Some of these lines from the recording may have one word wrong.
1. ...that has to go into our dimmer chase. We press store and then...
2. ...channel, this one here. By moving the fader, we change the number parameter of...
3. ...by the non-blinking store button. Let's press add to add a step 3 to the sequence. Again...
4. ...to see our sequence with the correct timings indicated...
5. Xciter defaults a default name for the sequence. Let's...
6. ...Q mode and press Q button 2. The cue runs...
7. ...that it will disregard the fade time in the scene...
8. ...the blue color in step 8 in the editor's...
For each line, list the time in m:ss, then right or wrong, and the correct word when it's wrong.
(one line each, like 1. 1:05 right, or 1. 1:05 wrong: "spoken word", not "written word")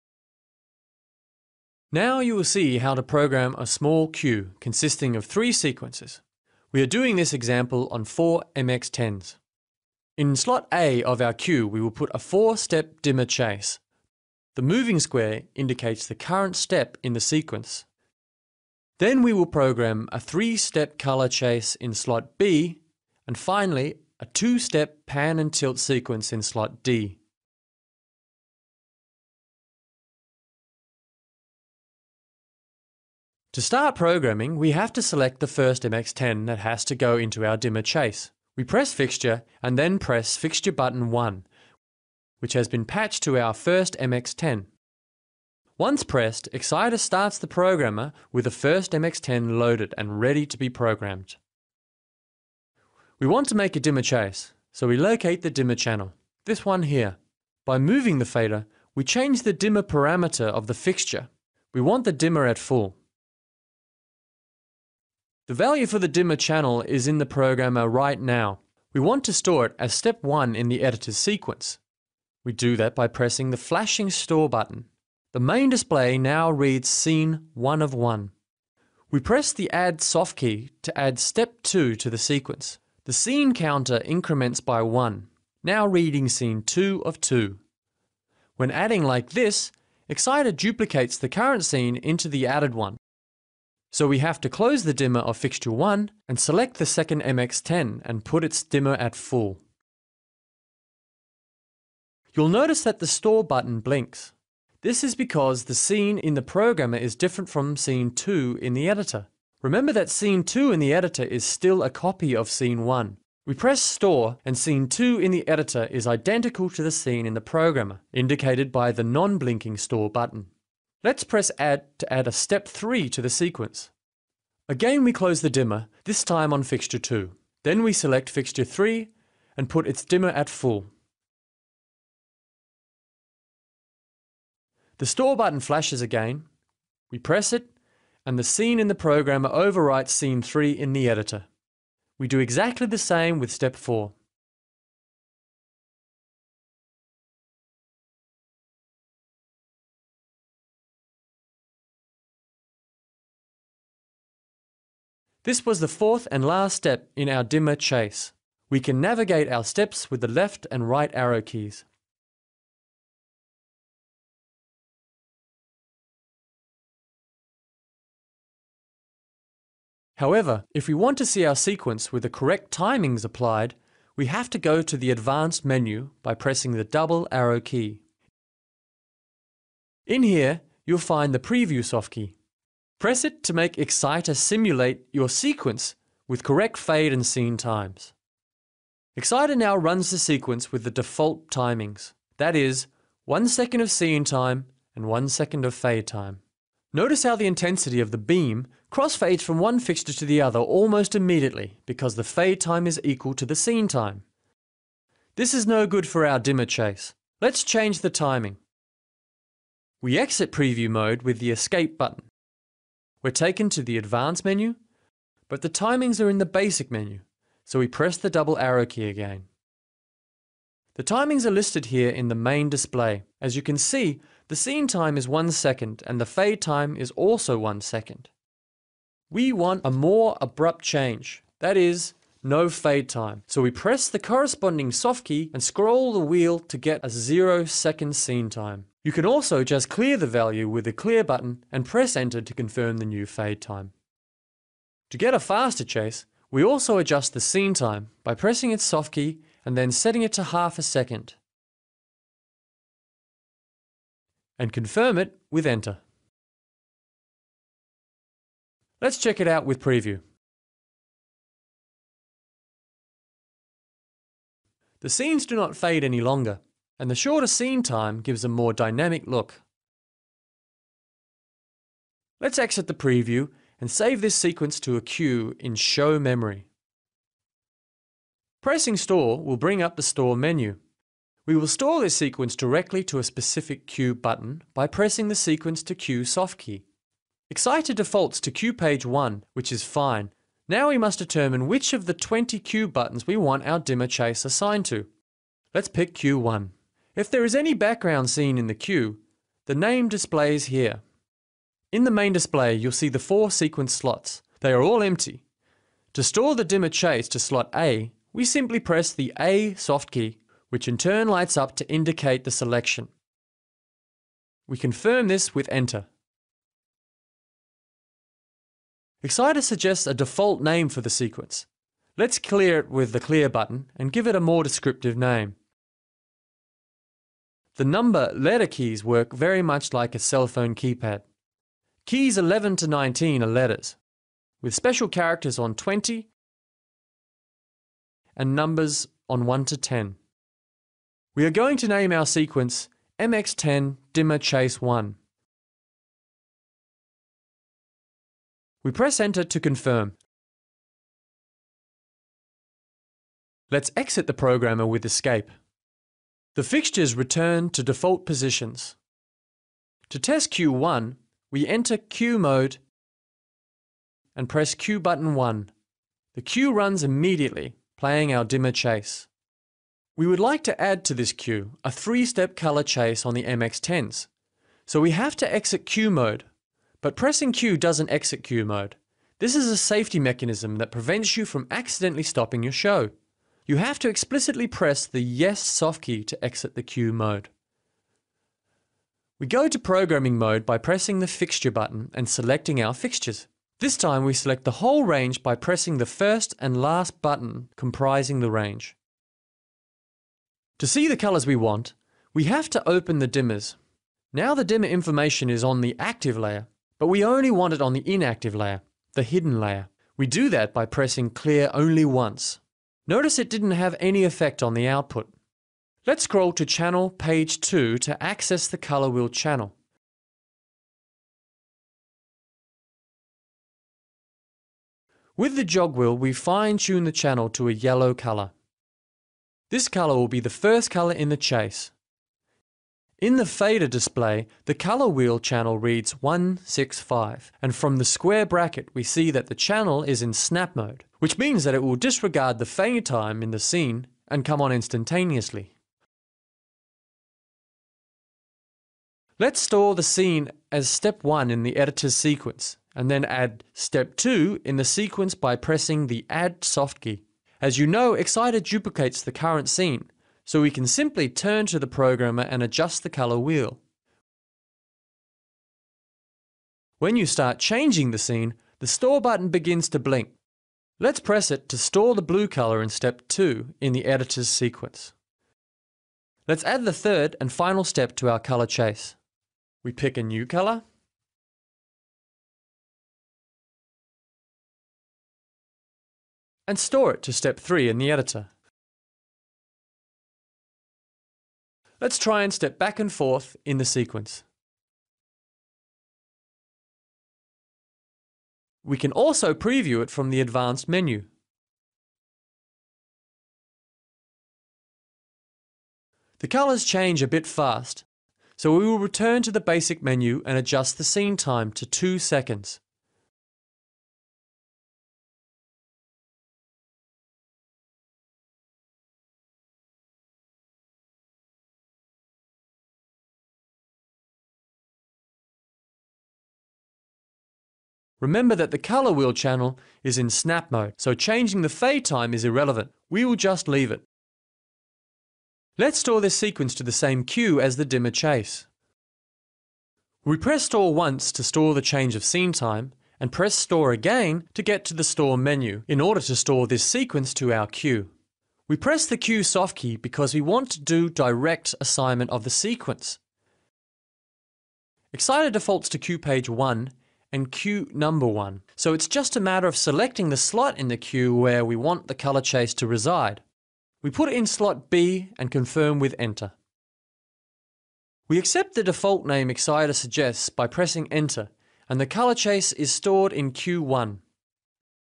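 1. 0:36 wrong: "fixture", not "store"
2. 0:55 wrong: "dimmer", not "number"
3. 1:58 right
4. 2:51 wrong: "applied", not "indicated"
5. 5:19 wrong: "suggests", not "defaults"
6. 6:01 wrong: "1", not "2"
7. 7:21 right
8. 7:52 wrong: "2", not "8".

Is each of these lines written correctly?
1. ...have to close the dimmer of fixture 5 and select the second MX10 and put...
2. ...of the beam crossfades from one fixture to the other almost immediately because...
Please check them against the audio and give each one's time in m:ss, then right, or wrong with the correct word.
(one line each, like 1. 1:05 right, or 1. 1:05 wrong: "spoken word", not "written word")
1. 1:34 wrong: "1", not "5"
2. 3:17 right.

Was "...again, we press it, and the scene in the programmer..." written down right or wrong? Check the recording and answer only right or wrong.
right.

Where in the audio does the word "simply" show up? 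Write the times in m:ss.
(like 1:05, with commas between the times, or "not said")
5:08, 7:40.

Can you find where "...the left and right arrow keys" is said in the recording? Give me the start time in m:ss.
2:40.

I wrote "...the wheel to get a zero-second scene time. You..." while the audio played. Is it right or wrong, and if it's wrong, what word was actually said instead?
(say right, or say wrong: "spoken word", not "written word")
right.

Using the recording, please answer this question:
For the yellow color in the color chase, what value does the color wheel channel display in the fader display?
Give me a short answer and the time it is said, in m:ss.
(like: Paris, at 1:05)
165, at 7:16.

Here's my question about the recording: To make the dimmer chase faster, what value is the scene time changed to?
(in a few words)
half a second.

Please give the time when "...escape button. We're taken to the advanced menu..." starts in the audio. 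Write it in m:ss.
3:31.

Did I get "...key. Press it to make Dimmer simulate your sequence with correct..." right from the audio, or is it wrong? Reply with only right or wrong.
wrong.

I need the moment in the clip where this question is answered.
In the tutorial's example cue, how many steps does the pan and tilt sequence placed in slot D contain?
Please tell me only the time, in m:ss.
0:24.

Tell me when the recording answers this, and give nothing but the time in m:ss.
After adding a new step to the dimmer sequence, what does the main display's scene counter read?
1:26.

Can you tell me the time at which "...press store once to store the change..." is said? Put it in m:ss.
9:00.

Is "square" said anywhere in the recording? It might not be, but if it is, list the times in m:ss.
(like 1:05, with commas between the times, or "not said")
0:15, 7:18.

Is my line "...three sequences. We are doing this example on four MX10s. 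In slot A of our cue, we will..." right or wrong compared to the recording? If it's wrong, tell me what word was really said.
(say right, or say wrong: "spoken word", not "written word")
right.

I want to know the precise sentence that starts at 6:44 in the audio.
Now the dimmer information is on the active layer, but we only want it on the inactive layer, the hidden layer.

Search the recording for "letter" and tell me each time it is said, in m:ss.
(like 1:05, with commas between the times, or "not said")
5:28, 5:33.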